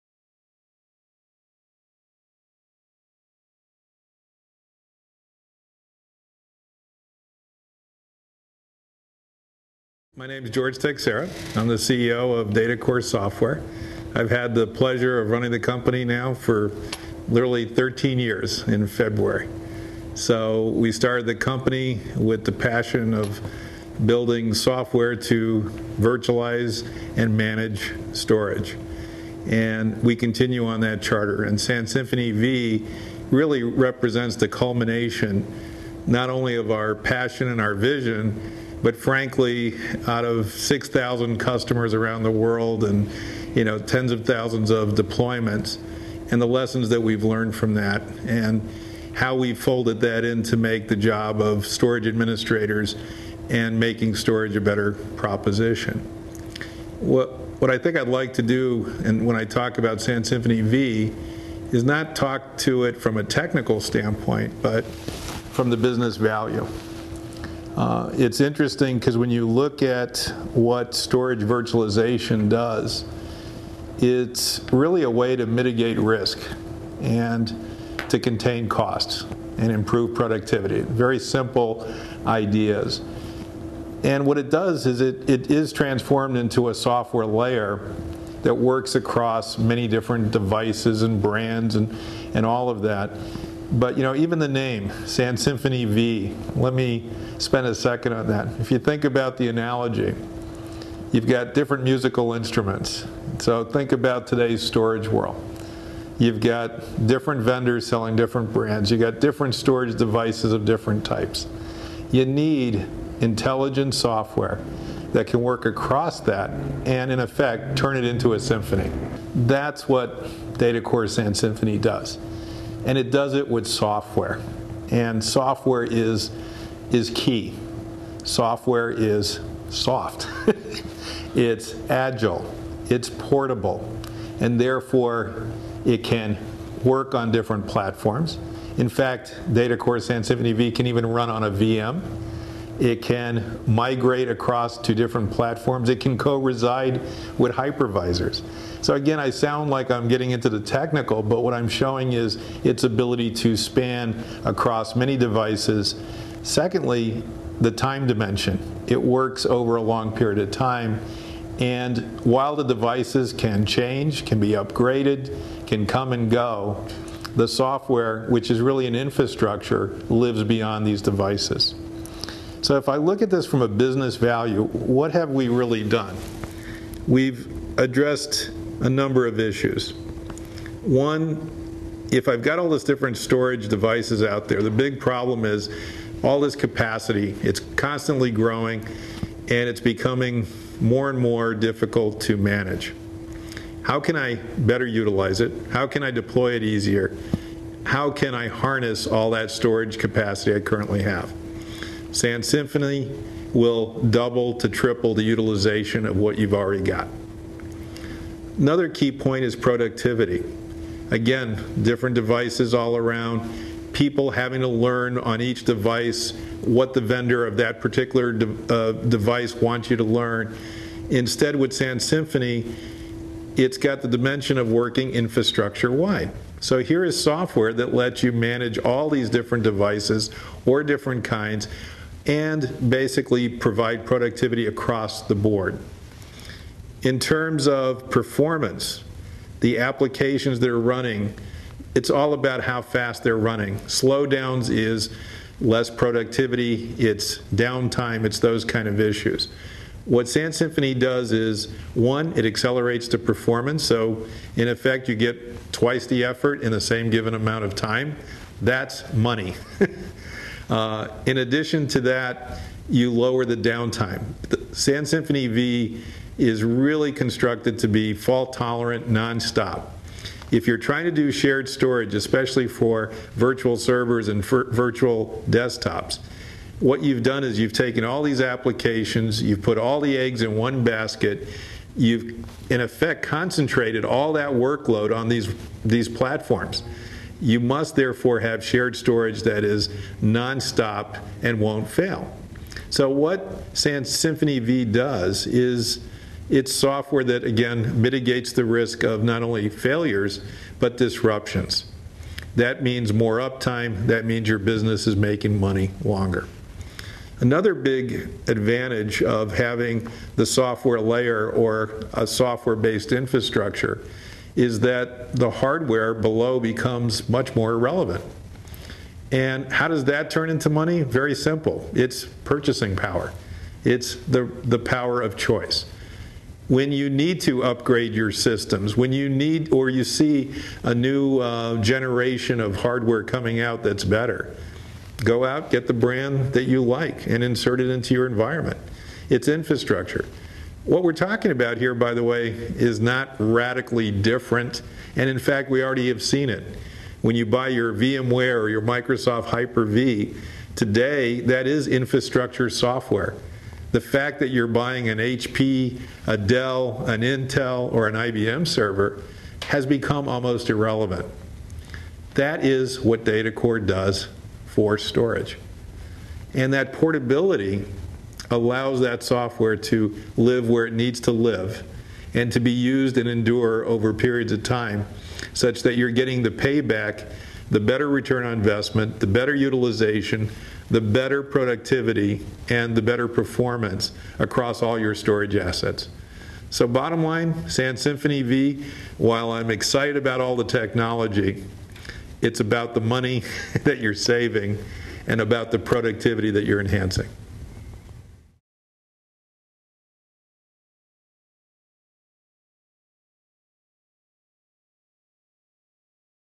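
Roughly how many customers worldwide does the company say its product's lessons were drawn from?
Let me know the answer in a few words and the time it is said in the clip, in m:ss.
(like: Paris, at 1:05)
6,000, at 0:40.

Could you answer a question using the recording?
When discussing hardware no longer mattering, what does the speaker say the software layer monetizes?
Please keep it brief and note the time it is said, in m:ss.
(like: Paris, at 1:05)
purchasing power, at 5:22.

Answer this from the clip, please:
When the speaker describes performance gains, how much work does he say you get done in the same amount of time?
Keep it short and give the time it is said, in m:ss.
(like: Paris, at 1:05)
twice the effort, at 4:15.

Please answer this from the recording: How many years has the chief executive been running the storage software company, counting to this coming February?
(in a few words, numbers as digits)
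13.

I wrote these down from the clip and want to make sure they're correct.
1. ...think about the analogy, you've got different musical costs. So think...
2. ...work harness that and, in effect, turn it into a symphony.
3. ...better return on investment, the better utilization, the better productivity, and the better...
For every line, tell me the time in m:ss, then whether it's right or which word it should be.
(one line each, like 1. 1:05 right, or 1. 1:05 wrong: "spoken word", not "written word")
1. 1:38 wrong: "instruments", not "costs"
2. 1:55 wrong: "across", not "harness"
3. 6:17 right.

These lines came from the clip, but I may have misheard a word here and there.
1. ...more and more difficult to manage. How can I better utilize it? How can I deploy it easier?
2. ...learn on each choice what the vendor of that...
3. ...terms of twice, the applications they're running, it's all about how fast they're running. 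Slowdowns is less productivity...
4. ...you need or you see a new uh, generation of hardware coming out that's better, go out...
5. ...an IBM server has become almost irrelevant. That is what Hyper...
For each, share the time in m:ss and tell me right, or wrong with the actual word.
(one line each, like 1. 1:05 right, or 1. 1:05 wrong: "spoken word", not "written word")
1. 3:10 right
2. 3:34 wrong: "device", not "choice"
3. 3:57 wrong: "performance", not "twice"
4. 5:29 right
5. 5:58 wrong: "DataCore", not "Hyper".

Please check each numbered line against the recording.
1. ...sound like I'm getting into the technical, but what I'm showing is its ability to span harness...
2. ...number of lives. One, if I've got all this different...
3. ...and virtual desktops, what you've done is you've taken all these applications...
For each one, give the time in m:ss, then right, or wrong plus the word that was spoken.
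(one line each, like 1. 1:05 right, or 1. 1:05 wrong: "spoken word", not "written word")
1. 2:29 wrong: "across", not "harness"
2. 2:58 wrong: "issues", not "lives"
3. 4:34 right.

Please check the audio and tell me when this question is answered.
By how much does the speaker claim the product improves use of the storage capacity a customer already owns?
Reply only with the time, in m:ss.
3:24.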